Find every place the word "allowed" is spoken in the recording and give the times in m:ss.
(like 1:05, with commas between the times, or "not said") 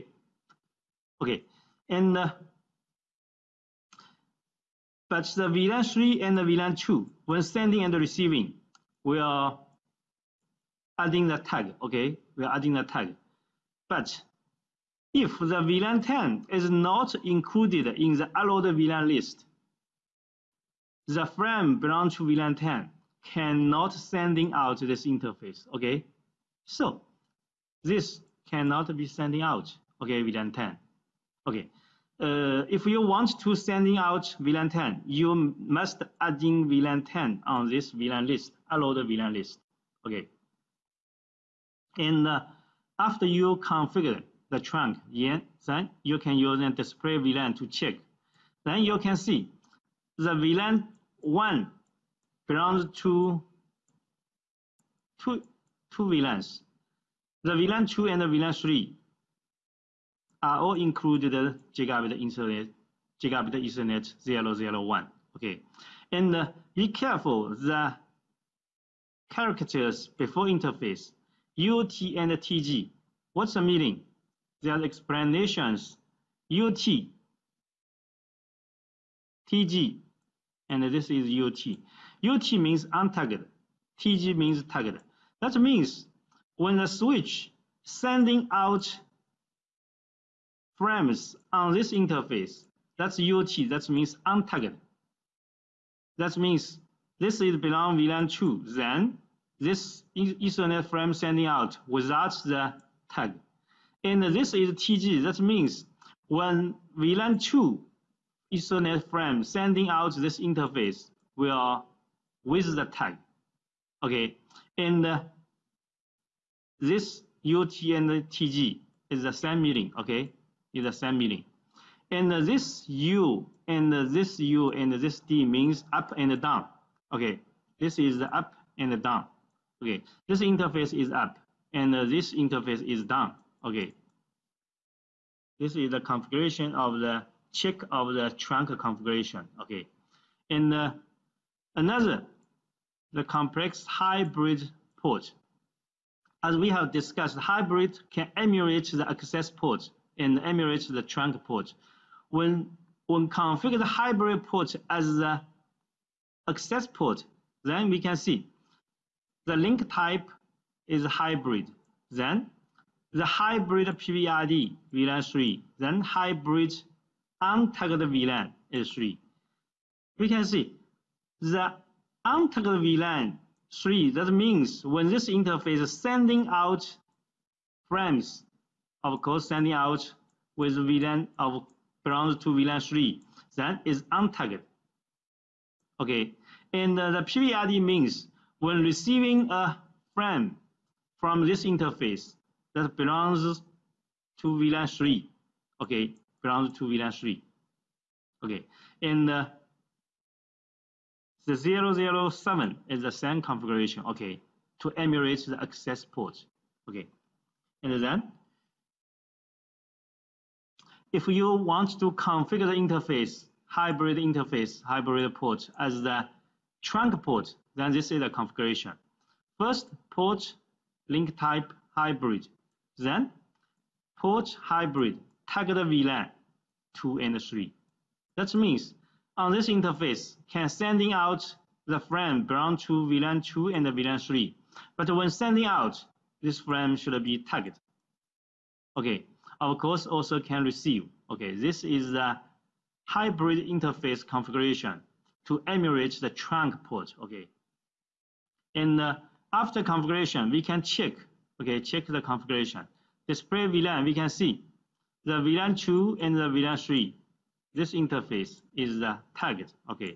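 0:18, 0:38.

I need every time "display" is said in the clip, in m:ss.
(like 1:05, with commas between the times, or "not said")
0:46, 4:13.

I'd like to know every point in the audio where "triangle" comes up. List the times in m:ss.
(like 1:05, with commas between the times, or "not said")
not said.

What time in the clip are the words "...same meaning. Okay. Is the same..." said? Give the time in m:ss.
1:59.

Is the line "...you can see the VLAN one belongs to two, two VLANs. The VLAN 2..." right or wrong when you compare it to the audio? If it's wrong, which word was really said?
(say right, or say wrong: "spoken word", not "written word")
right.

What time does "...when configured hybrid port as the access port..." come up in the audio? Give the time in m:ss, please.
2:33.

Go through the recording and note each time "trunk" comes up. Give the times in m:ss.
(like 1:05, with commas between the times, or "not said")
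0:44, 2:18, 2:31, 3:36, 4:06.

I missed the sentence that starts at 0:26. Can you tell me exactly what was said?
So this cannot be sending out, okay, VLAN 10.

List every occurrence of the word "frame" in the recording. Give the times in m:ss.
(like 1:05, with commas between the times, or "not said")
0:21, 1:30, 1:40, 1:49, 2:57, 3:10, 3:51, 3:56.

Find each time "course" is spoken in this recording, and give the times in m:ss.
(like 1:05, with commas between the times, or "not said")
2:59, 3:59.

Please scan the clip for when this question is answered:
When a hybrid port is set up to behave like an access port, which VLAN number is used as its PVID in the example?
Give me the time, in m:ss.
2:43.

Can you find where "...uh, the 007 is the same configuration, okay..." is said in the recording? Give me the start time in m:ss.
3:19.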